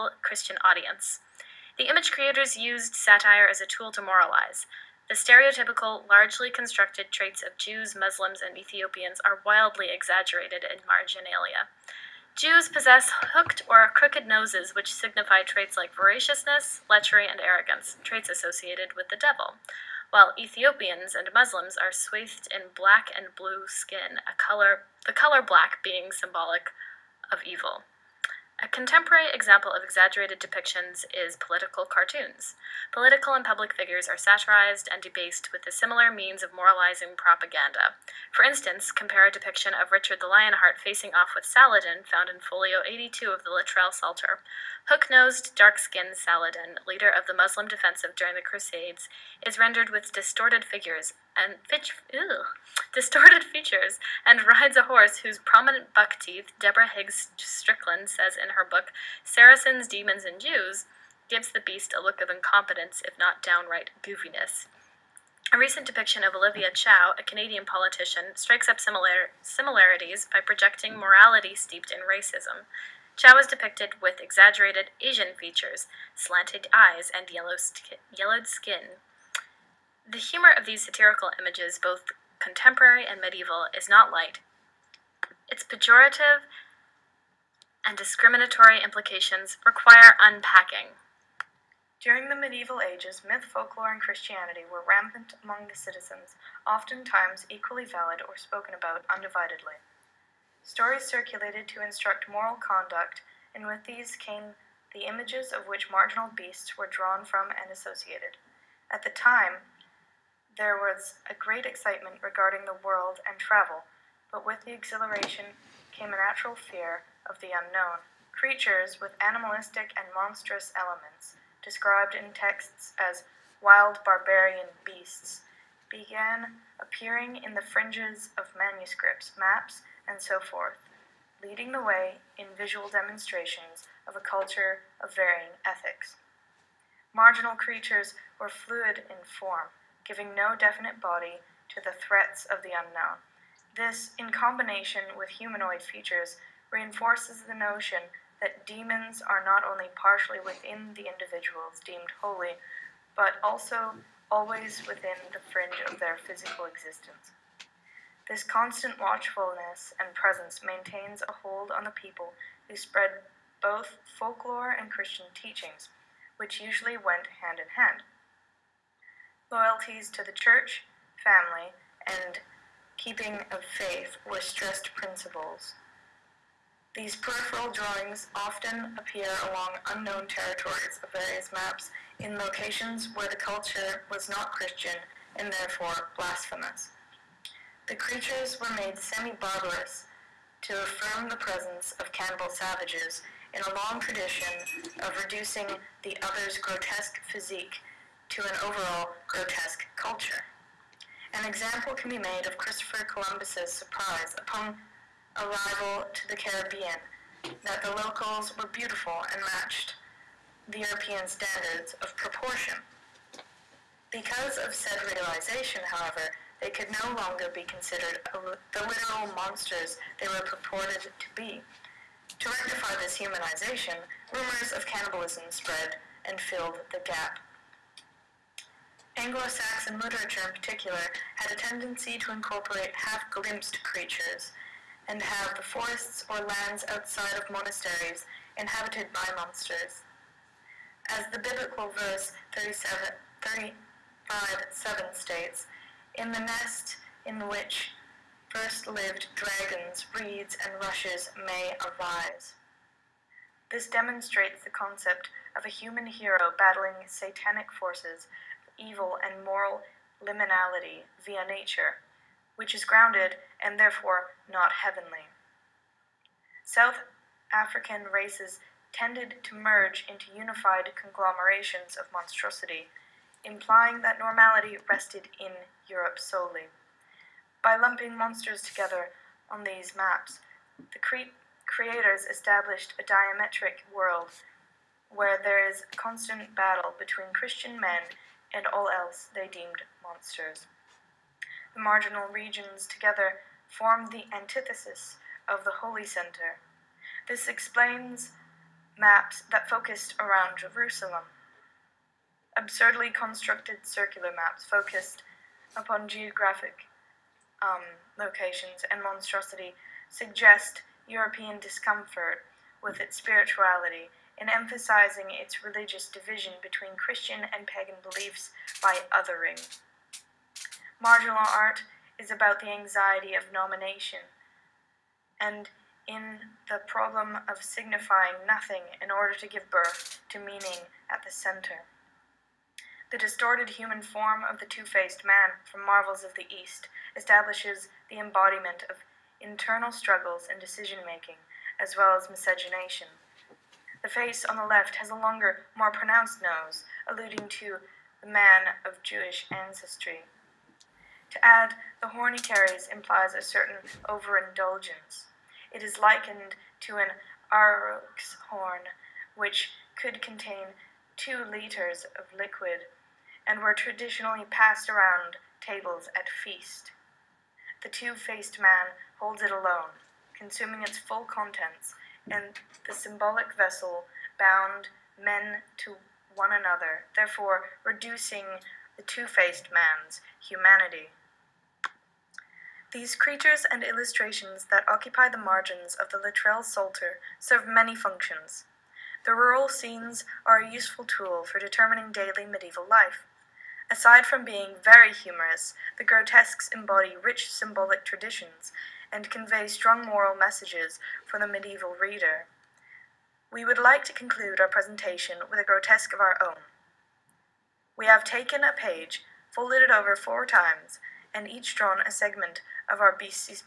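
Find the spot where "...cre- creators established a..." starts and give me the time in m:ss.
4:40.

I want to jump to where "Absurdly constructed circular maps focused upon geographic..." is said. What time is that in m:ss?
5:02.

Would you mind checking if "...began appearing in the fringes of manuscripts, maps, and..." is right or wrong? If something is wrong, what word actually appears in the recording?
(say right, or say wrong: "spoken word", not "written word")
right.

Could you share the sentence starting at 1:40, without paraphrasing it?
Stories circulated to instruct moral conduct, and with these came the images of which marginal beasts were drawn from and associated.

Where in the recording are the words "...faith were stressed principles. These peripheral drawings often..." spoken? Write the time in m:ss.
2:53.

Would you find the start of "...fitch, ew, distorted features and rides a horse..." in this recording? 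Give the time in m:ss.
0:51.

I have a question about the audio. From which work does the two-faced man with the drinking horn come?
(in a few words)
Marvels of the East.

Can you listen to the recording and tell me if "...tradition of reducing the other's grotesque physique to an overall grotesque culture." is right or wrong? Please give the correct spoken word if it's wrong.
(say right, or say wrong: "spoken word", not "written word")
right.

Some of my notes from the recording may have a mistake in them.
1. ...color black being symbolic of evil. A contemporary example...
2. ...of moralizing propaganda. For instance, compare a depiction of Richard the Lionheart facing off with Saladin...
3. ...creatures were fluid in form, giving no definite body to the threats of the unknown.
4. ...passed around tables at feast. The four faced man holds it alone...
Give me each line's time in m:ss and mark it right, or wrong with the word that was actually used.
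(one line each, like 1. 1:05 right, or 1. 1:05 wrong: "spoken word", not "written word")
1. 0:25 right
2. 0:36 right
3. 2:17 right
4. 6:04 wrong: "two", not "four".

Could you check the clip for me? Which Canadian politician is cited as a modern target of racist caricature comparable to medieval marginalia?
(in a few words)
Olivia Chow.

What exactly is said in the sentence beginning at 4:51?
The marginal regions together form the antithesis of the holy center.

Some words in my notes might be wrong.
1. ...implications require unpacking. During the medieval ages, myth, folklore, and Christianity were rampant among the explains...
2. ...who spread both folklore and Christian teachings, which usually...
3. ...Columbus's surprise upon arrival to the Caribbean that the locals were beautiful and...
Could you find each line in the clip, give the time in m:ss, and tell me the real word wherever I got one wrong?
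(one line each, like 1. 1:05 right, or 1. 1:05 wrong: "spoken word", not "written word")
1. 1:28 wrong: "citizens", not "explains"
2. 2:42 right
3. 3:23 right.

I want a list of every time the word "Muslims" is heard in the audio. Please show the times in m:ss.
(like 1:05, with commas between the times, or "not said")
0:07, 0:21, 0:47.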